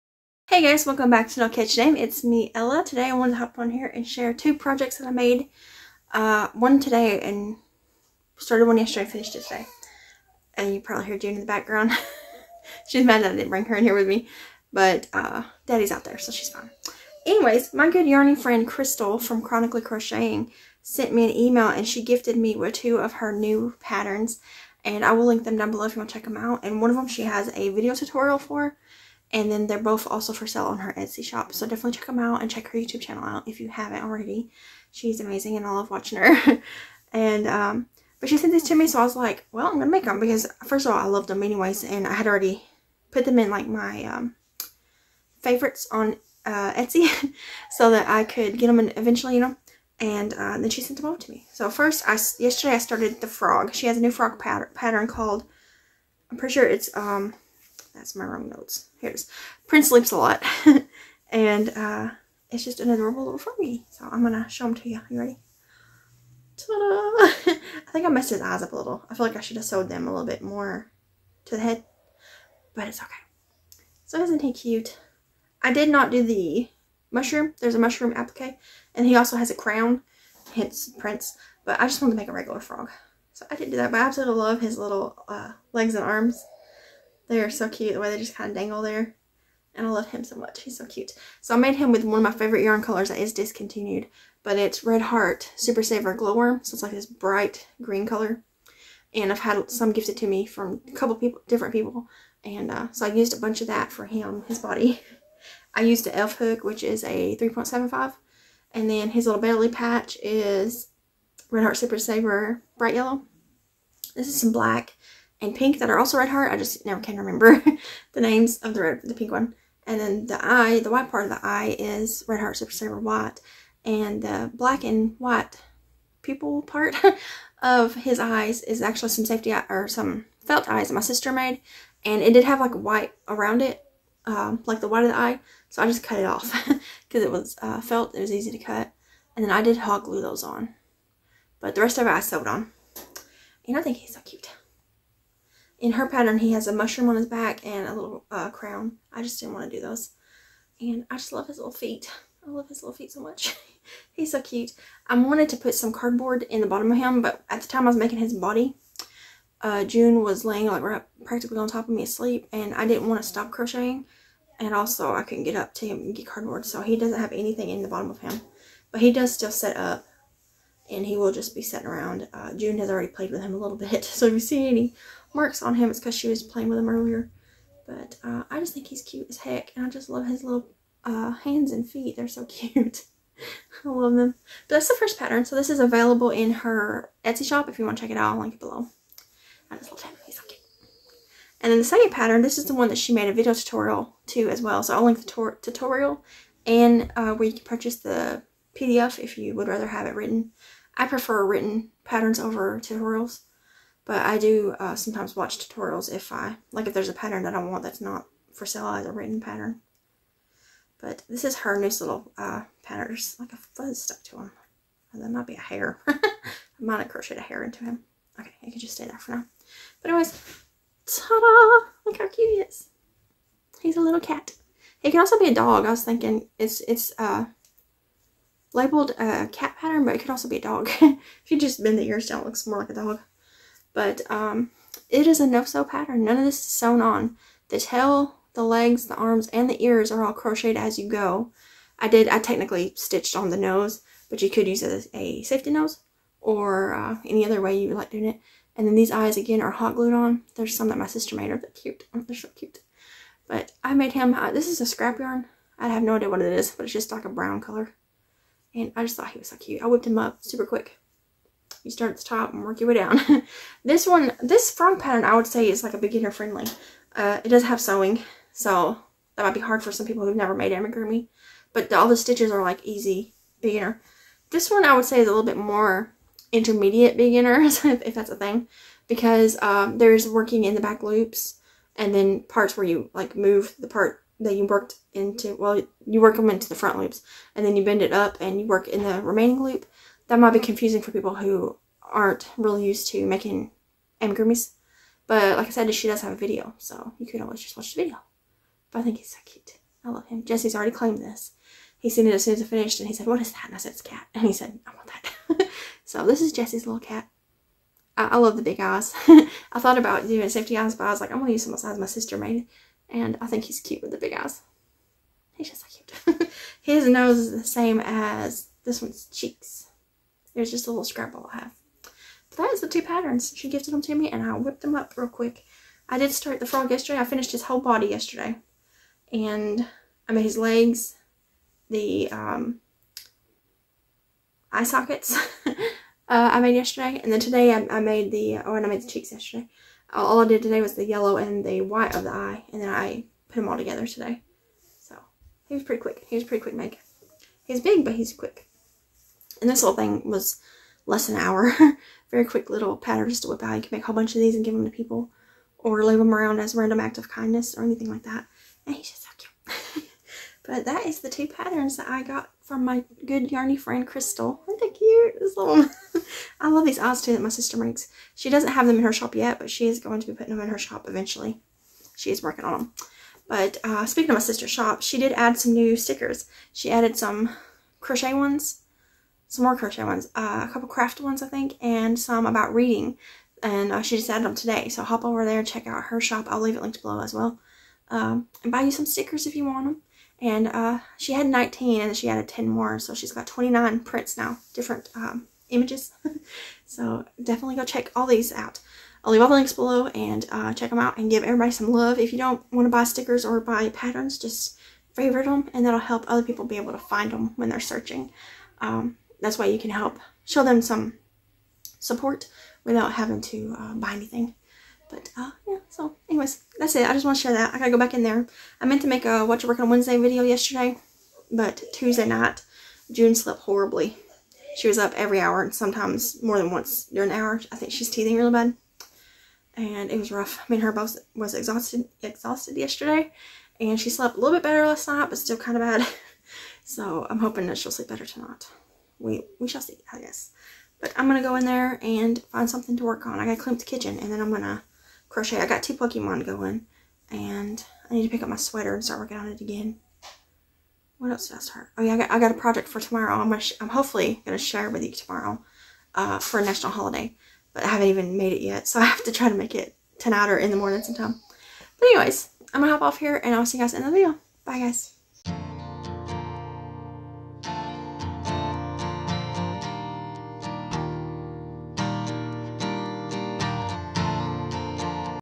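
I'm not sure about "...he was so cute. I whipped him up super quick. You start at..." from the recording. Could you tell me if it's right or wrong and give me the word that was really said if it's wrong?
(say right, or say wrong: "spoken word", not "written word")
right.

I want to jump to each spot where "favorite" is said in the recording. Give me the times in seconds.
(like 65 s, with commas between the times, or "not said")
45 s, 92 s, 405 s.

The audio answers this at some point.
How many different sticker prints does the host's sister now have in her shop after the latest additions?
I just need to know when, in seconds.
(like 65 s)
393 s.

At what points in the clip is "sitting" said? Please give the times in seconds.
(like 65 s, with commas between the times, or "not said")
171 s.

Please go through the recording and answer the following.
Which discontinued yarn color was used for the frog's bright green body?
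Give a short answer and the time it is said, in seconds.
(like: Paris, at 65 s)
Glowworm, at 96 s.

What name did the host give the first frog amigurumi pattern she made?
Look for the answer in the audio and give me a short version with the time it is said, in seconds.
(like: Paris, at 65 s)
Prince Leaps a lot, at 59 s.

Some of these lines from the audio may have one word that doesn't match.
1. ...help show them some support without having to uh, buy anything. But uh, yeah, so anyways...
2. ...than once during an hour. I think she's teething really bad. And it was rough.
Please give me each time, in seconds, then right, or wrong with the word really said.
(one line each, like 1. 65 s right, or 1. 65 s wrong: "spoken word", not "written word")
1. 409 s right
2. 426 s right.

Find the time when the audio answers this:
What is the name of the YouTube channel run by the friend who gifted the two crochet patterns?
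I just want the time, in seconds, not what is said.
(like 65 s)
19 s.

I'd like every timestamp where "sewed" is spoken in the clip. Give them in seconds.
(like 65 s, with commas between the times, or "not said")
69 s, 142 s.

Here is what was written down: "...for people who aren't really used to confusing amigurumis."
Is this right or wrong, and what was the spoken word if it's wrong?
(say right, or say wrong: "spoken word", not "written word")
wrong: "making", not "confusing".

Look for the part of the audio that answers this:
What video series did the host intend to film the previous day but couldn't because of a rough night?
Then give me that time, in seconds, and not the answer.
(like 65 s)
419 s.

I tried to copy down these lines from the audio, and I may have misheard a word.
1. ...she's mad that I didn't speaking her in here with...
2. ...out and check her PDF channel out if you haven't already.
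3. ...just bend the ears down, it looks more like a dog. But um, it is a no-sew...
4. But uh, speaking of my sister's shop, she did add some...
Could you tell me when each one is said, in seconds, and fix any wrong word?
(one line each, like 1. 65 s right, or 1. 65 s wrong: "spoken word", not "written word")
1. 12 s wrong: "bring", not "speaking"
2. 32 s wrong: "YouTube", not "PDF"
3. 231 s right
4. 373 s right.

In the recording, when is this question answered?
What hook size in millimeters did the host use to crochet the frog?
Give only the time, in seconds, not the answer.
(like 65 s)
107 s.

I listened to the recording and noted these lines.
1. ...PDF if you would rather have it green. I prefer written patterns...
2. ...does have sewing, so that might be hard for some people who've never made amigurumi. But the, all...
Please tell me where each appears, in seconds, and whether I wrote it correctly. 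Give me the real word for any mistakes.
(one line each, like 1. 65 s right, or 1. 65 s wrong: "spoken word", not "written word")
1. 198 s wrong: "written", not "green"
2. 267 s right.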